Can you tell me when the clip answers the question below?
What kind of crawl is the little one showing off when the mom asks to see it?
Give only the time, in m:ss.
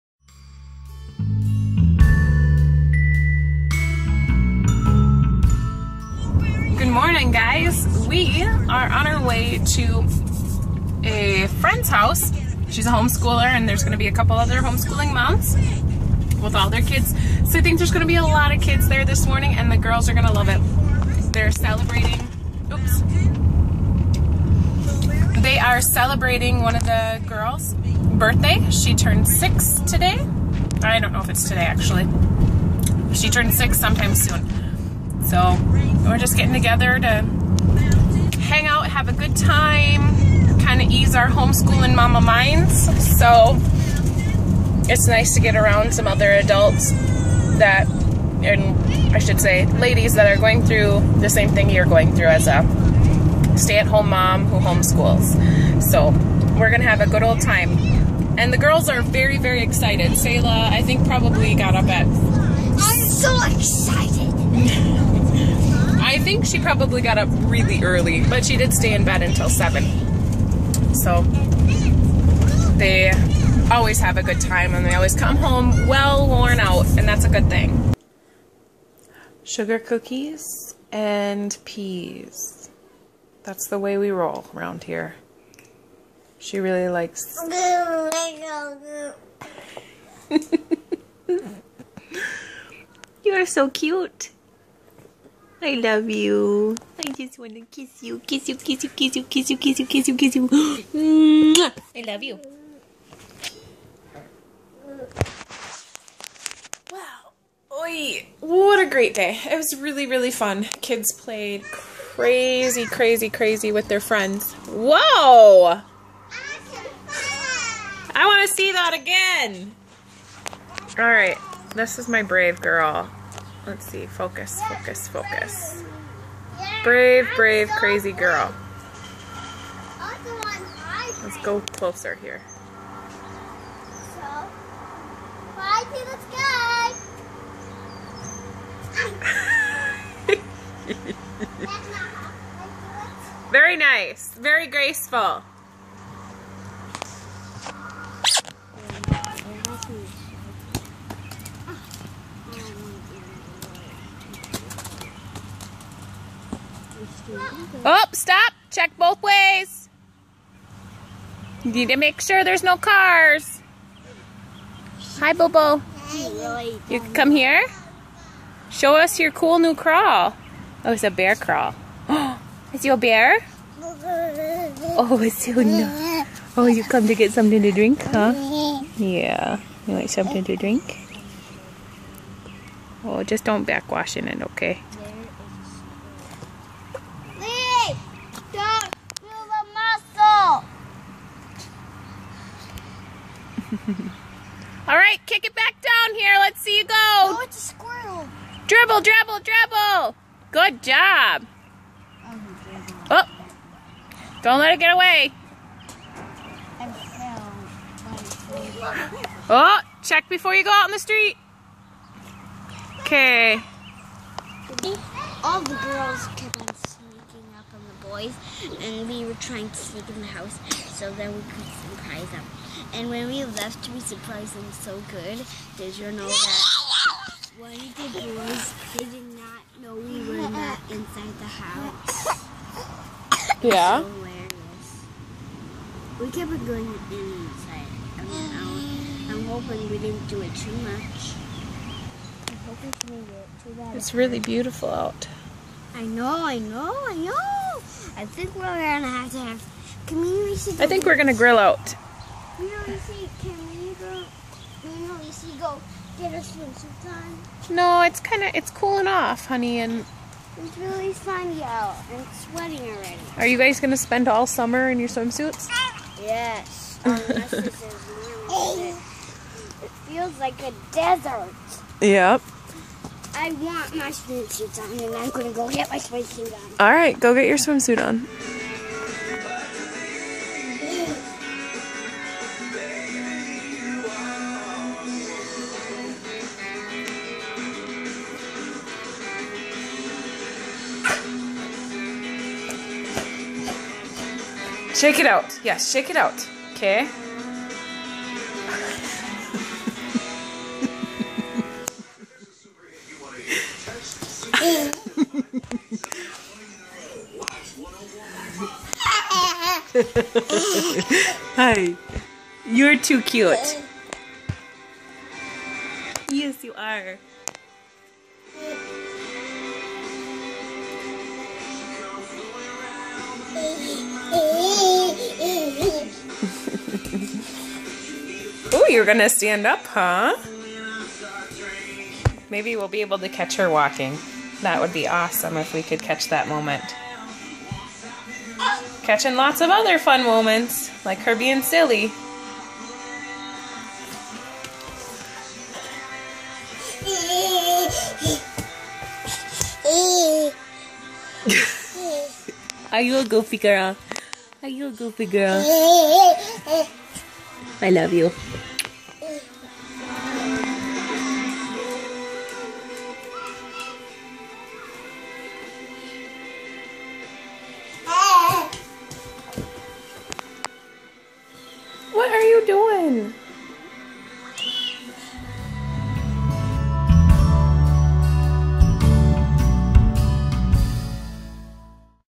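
2:51.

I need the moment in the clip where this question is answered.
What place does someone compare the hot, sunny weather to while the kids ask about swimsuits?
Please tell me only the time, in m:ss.
4:30.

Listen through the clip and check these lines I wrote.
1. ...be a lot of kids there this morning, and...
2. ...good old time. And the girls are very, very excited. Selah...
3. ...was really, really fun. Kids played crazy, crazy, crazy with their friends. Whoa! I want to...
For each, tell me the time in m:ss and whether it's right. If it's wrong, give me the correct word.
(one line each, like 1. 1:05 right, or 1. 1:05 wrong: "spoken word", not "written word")
1. 0:18 right
2. 0:57 right
3. 1:49 right.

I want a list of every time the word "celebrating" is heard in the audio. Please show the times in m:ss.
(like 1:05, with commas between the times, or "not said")
0:21, 0:25.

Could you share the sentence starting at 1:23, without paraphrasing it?
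That's the way we roll around here.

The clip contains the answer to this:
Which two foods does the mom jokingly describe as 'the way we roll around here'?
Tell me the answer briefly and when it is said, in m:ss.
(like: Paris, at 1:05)
Sugar cookies and peas, at 1:19.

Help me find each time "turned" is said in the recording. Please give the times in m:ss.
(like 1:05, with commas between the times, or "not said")
0:28, 0:33.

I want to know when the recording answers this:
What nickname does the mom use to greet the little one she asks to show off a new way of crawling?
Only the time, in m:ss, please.
2:45.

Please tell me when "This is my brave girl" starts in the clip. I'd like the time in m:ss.
2:01.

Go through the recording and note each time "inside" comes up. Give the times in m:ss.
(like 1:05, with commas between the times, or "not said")
3:50, 3:56.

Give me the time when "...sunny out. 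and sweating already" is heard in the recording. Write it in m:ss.
4:21.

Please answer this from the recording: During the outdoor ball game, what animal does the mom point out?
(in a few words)
Squirrel.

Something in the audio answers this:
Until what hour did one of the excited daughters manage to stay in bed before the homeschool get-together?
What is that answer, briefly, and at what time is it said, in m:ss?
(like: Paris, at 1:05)
7, at 1:09.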